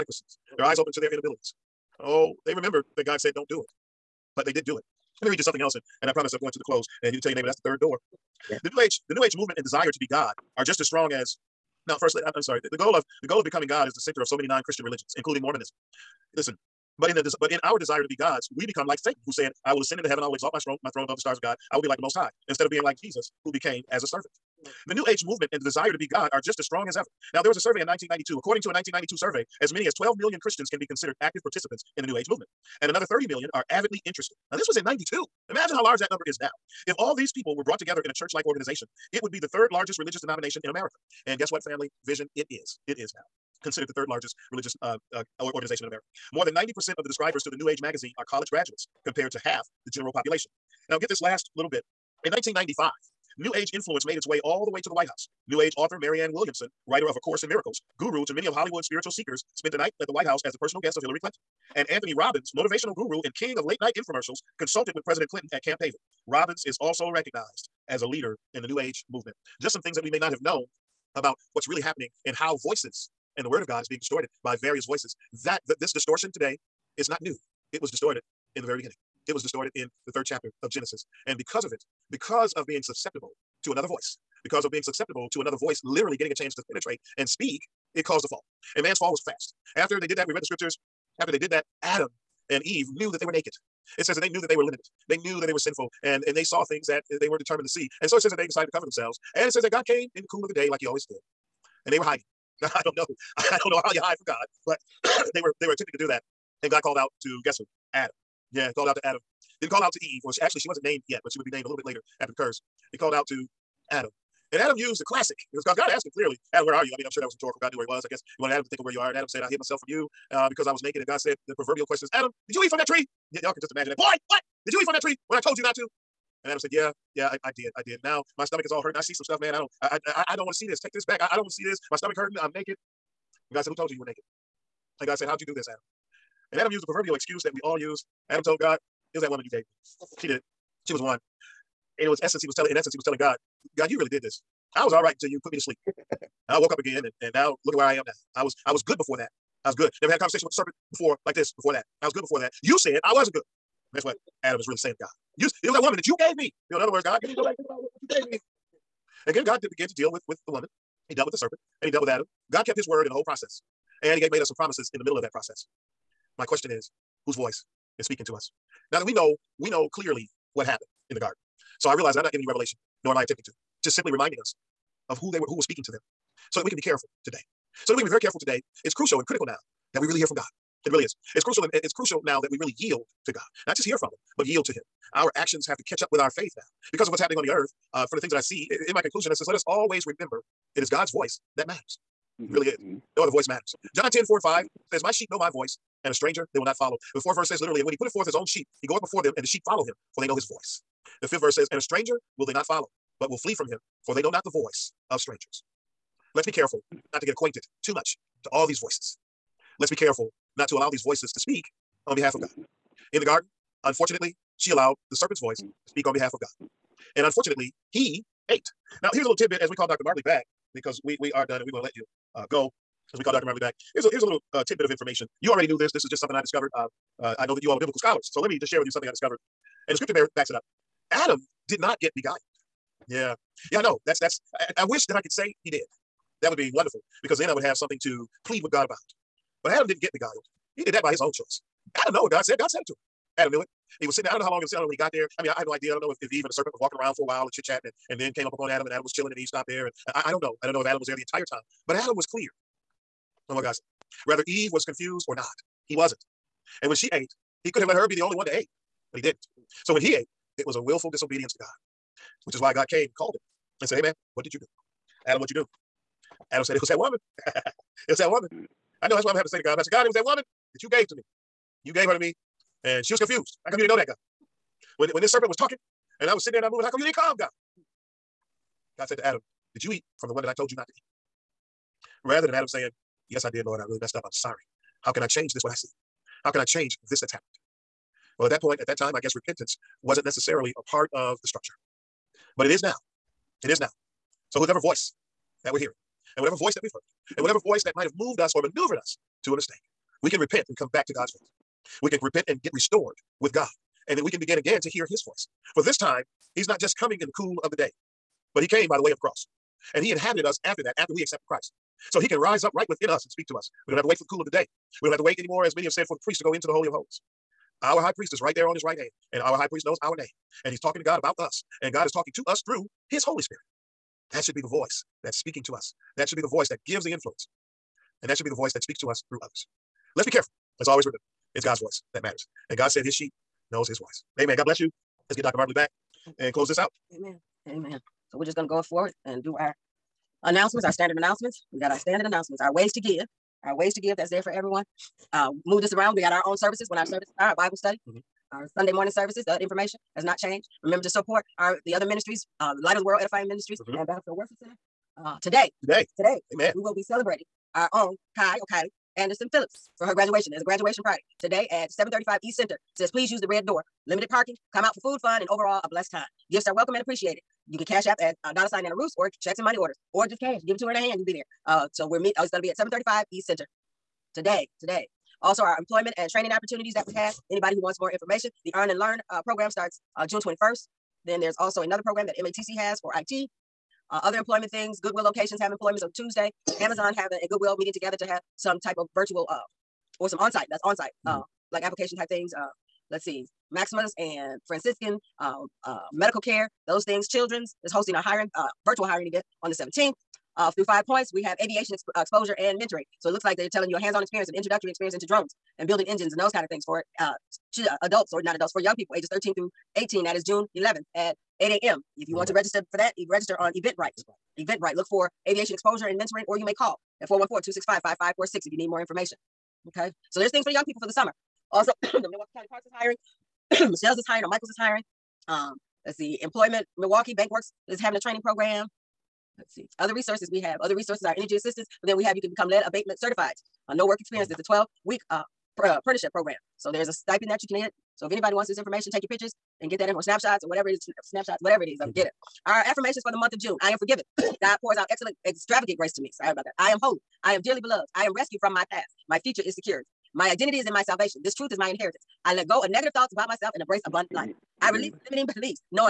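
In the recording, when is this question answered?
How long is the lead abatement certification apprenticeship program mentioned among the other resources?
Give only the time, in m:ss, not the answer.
7:14.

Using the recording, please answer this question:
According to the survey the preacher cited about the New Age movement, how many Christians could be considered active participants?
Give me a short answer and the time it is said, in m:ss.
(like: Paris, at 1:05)
12 million, at 0:29.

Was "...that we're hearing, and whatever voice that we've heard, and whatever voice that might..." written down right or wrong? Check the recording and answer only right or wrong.
right.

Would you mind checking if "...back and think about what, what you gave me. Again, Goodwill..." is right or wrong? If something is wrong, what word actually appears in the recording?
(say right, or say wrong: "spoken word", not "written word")
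wrong: "God", not "Goodwill".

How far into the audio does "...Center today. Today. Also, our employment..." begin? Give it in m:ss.
6:13.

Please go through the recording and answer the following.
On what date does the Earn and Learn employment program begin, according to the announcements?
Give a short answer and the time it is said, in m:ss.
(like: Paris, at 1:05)
June 21, at 6:20.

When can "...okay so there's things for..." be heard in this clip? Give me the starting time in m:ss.
6:59.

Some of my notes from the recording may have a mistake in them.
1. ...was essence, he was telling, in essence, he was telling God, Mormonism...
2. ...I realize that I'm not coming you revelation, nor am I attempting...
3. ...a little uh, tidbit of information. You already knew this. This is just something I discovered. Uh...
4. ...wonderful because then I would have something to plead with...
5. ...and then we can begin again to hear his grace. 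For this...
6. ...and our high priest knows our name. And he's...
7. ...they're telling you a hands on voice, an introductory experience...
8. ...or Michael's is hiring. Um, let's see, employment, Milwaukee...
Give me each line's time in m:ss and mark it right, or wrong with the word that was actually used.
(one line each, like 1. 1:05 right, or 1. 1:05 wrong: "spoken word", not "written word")
1. 2:22 wrong: "God", not "Mormonism"
2. 2:51 wrong: "giving", not "coming"
3. 3:44 right
4. 3:56 right
5. 5:04 wrong: "voice", not "grace"
6. 5:19 right
7. 6:43 wrong: "experience", not "voice"
8. 7:04 right.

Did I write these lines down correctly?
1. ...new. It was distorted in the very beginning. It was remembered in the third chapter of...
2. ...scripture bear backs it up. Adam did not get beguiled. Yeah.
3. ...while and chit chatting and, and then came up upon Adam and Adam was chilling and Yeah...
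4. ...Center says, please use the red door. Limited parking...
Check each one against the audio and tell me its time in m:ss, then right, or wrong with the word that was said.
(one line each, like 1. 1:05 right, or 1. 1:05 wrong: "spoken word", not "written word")
1. 1:17 wrong: "distorted", not "remembered"
2. 3:49 right
3. 4:07 wrong: "Eve", not "Yeah"
4. 6:02 right.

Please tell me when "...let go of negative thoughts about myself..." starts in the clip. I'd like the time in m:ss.
7:32.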